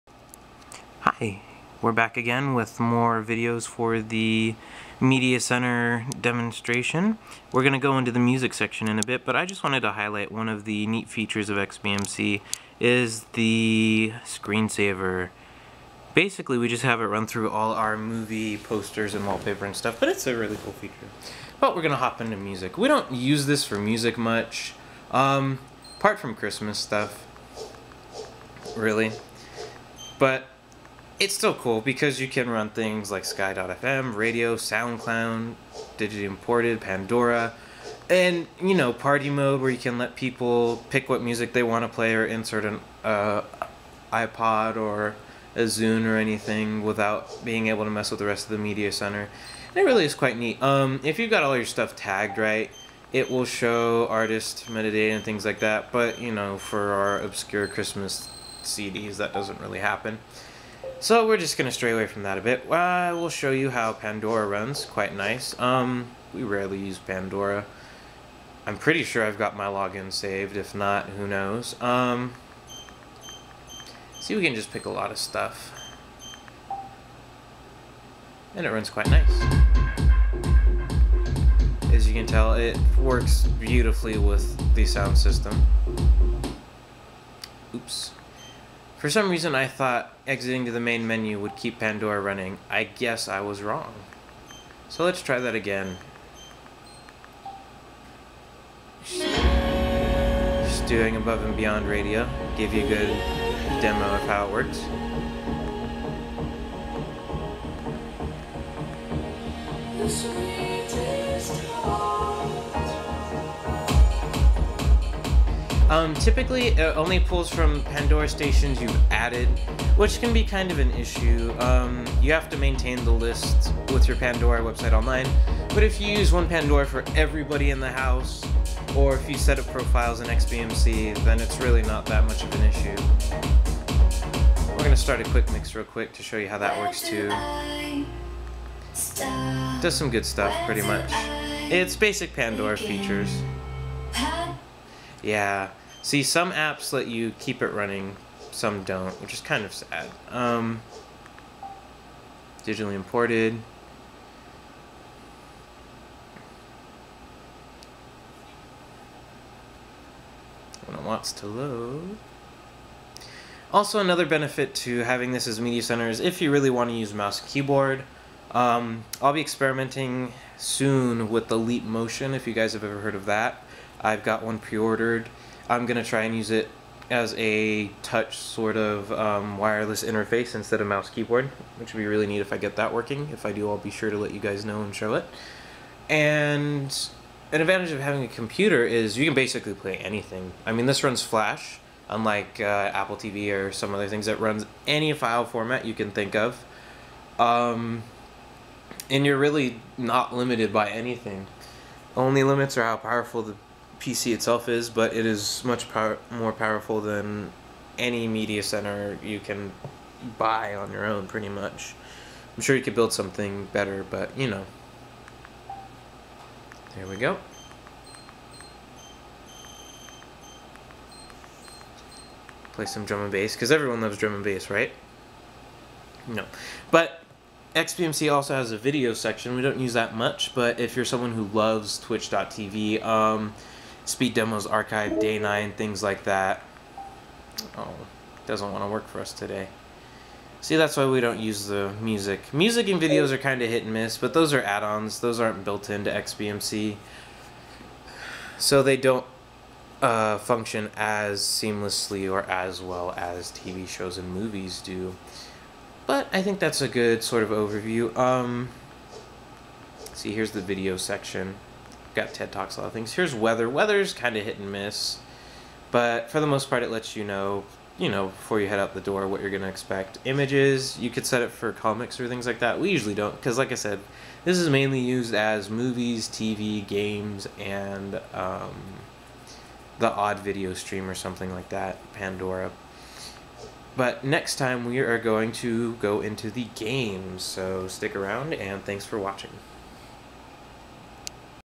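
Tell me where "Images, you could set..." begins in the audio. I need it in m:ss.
4:30.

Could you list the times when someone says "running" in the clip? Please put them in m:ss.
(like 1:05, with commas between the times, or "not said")
1:32, 2:27.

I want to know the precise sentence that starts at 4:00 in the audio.
See, that's why we don't use the music.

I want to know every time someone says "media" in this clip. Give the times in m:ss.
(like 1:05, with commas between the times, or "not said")
0:04, 0:48, 2:45, 3:28.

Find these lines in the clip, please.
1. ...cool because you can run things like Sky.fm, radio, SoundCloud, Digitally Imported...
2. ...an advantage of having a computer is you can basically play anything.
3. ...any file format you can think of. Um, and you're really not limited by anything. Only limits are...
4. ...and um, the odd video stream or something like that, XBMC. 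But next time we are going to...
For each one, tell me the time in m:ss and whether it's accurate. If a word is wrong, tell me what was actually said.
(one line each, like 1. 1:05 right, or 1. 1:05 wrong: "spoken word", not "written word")
1. 0:31 right
2. 3:07 right
3. 3:14 right
4. 4:37 wrong: "Pandora", not "XBMC".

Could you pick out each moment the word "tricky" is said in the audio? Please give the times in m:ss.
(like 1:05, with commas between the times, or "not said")
not said.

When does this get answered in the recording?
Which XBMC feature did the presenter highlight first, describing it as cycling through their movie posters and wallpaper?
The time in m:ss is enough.
0:14.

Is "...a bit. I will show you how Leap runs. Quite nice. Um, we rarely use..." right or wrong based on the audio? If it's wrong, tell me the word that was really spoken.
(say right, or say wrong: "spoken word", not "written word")
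wrong: "Pandora", not "Leap".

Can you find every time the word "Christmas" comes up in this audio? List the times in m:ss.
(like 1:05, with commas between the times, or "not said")
0:26, 0:57.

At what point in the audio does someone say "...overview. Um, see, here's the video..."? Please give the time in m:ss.
4:17.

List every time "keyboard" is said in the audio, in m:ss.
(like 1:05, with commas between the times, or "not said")
2:47, 3:01.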